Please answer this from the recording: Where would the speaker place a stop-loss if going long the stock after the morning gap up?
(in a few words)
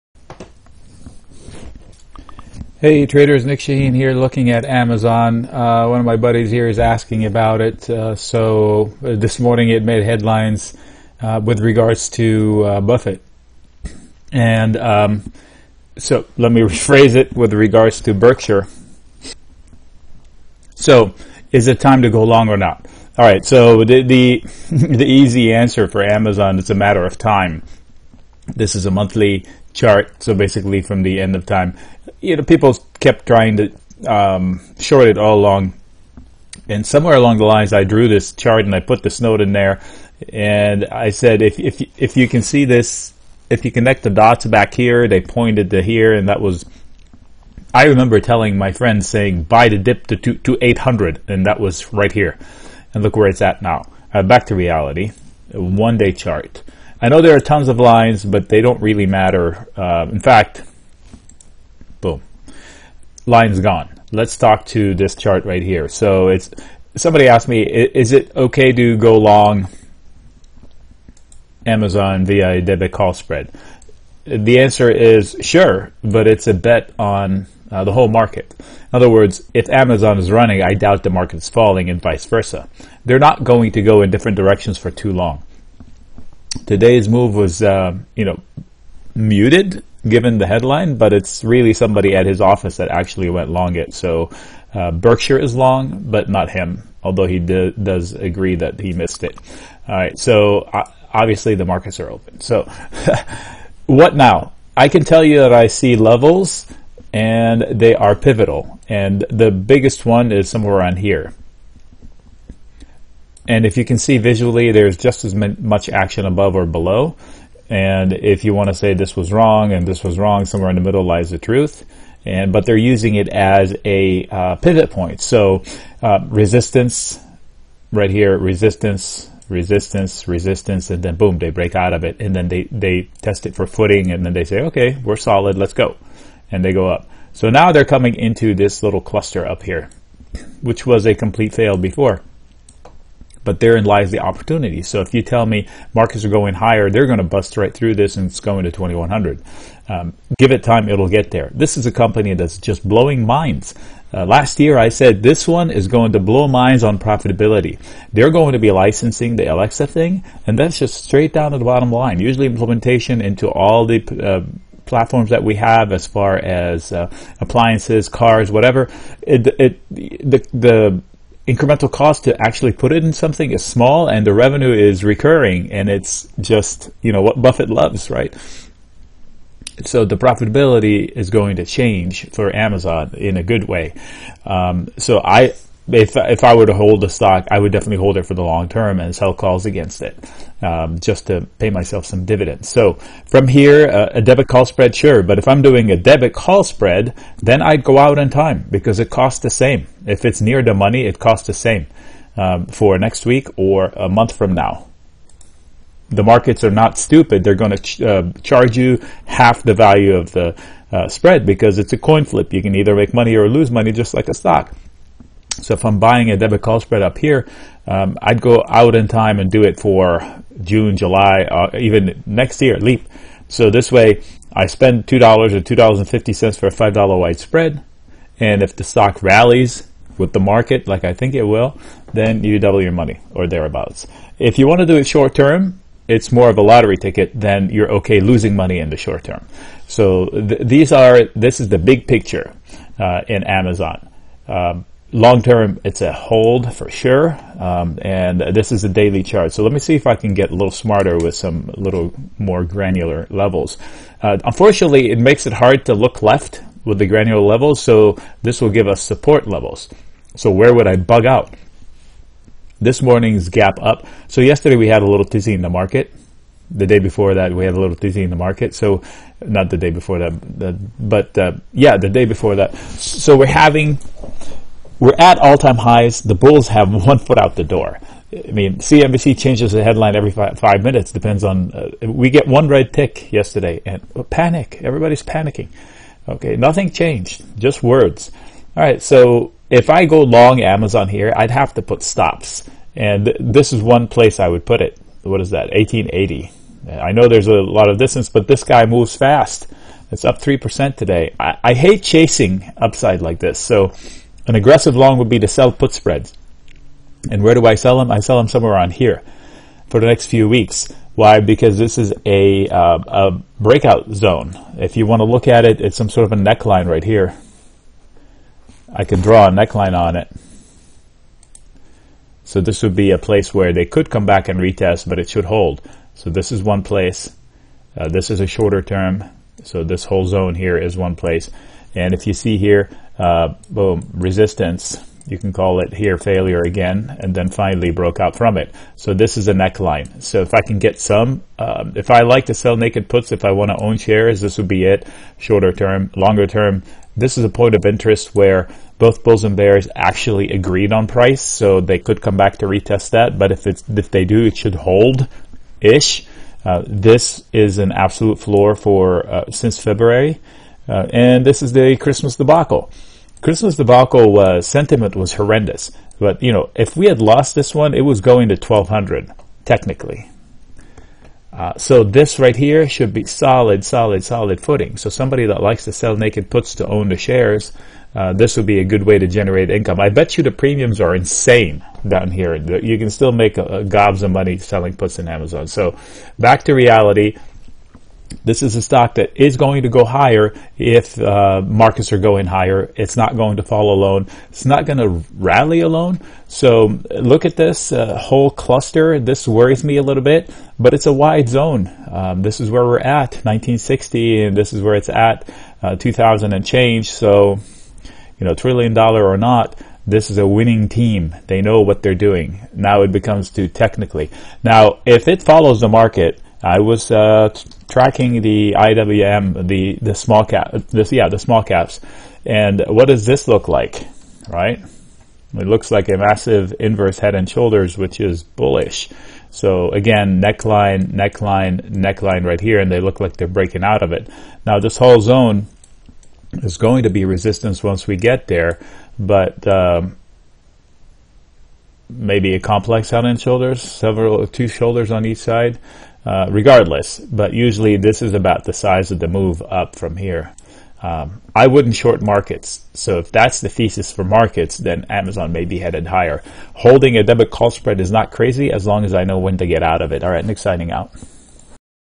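1880.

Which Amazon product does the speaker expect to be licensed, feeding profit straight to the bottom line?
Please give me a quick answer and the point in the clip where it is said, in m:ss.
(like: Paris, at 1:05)
Alexa, at 2:39.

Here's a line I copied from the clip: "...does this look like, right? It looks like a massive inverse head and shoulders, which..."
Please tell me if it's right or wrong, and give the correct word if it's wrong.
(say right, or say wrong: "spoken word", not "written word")
right.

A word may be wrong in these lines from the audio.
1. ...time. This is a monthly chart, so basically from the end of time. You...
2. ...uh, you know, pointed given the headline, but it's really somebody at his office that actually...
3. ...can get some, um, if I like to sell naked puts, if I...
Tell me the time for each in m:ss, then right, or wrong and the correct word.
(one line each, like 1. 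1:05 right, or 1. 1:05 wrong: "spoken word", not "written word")
1. 0:27 right
2. 1:27 wrong: "muted", not "pointed"
3. 5:40 right.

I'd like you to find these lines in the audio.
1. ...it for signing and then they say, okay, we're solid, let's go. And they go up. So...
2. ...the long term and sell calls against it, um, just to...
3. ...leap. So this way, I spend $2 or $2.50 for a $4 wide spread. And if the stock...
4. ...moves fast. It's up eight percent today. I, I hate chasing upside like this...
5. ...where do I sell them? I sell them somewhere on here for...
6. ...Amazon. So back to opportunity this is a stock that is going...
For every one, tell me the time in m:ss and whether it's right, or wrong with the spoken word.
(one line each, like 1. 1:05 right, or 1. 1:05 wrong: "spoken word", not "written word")
1. 2:13 wrong: "footing", not "signing"
2. 3:08 right
3. 3:42 wrong: "5", not "4"
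4. 4:58 wrong: "three", not "eight"
5. 5:07 right
6. 6:25 wrong: "reality", not "opportunity".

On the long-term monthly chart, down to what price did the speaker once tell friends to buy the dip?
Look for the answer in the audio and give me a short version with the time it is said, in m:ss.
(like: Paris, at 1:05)
800, at 0:50.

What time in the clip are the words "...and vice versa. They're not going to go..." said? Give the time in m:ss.
1:21.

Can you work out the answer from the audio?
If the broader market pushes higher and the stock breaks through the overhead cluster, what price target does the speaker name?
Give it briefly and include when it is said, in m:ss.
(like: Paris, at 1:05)
2100, at 2:28.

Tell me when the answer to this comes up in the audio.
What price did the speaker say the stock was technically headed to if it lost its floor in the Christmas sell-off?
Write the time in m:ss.
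6:08.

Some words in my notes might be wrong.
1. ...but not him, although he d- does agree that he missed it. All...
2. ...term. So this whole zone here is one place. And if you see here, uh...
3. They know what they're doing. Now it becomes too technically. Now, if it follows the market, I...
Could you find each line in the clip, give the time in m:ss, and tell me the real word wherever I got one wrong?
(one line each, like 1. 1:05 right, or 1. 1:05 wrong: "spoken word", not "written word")
1. 1:36 right
2. 5:28 right
3. 6:51 right.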